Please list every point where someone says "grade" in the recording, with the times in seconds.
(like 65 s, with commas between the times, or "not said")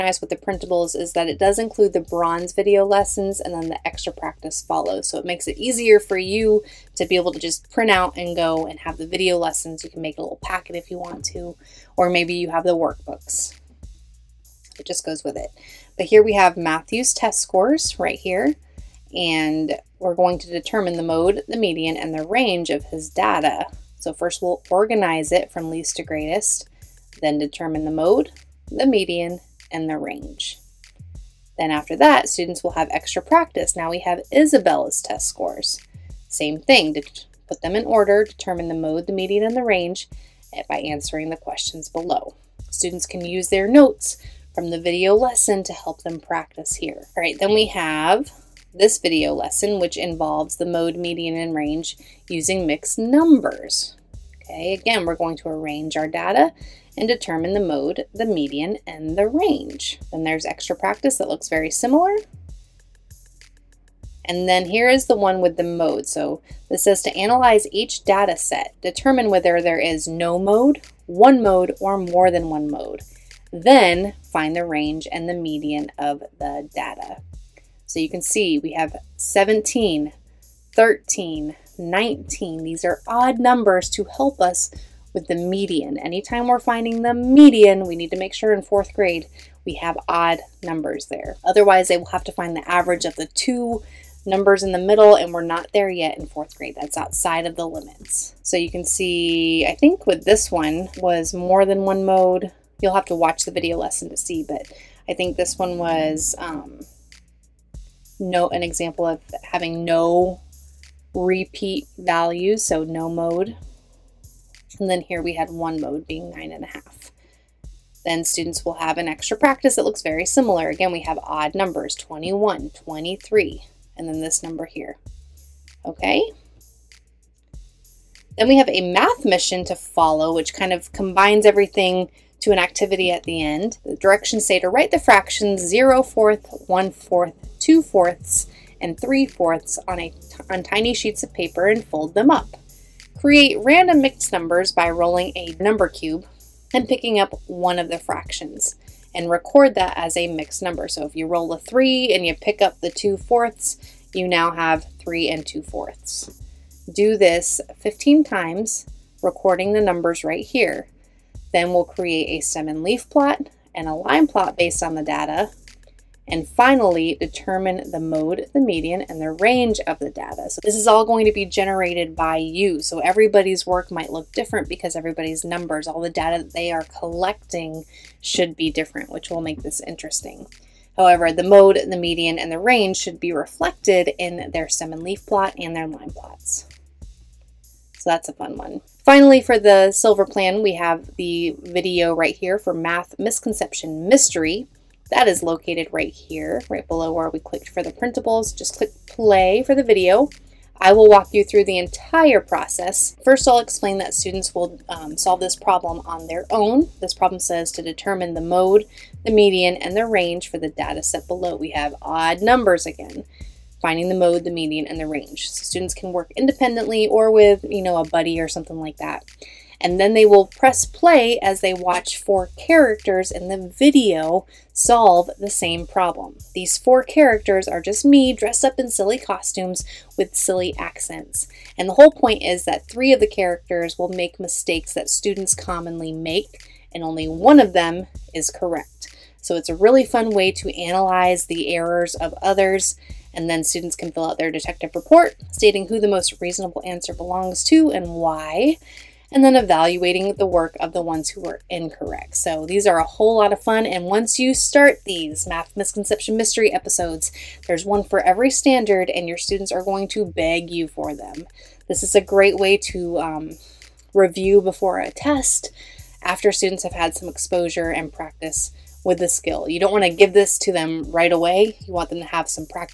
88 s, 96 s.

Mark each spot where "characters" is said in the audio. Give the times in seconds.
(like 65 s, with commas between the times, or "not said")
222 s, 227 s, 233 s.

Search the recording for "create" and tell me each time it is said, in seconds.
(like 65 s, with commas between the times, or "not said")
143 s, 161 s.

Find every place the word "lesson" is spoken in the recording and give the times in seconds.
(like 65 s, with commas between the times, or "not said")
2 s, 9 s, 45 s, 49 s, 103 s.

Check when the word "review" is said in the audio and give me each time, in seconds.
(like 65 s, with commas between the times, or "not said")
264 s.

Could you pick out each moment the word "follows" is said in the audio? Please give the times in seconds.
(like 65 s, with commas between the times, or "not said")
4 s, 129 s.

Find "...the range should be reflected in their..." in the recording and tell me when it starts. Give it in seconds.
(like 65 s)
182 s.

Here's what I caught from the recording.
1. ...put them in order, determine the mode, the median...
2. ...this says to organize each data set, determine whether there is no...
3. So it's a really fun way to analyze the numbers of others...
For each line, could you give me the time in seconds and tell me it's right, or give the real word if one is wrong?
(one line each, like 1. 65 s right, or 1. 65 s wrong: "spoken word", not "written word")
1. 37 s right
2. 66 s wrong: "analyze", not "organize"
3. 239 s wrong: "errors", not "numbers".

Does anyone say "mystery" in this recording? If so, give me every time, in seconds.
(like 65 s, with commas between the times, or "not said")
194 s, 256 s.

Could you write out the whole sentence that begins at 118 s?
Then students will have an extra practice that looks very similar.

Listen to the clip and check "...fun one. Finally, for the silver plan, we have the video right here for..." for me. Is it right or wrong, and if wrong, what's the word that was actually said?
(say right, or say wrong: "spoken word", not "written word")
right.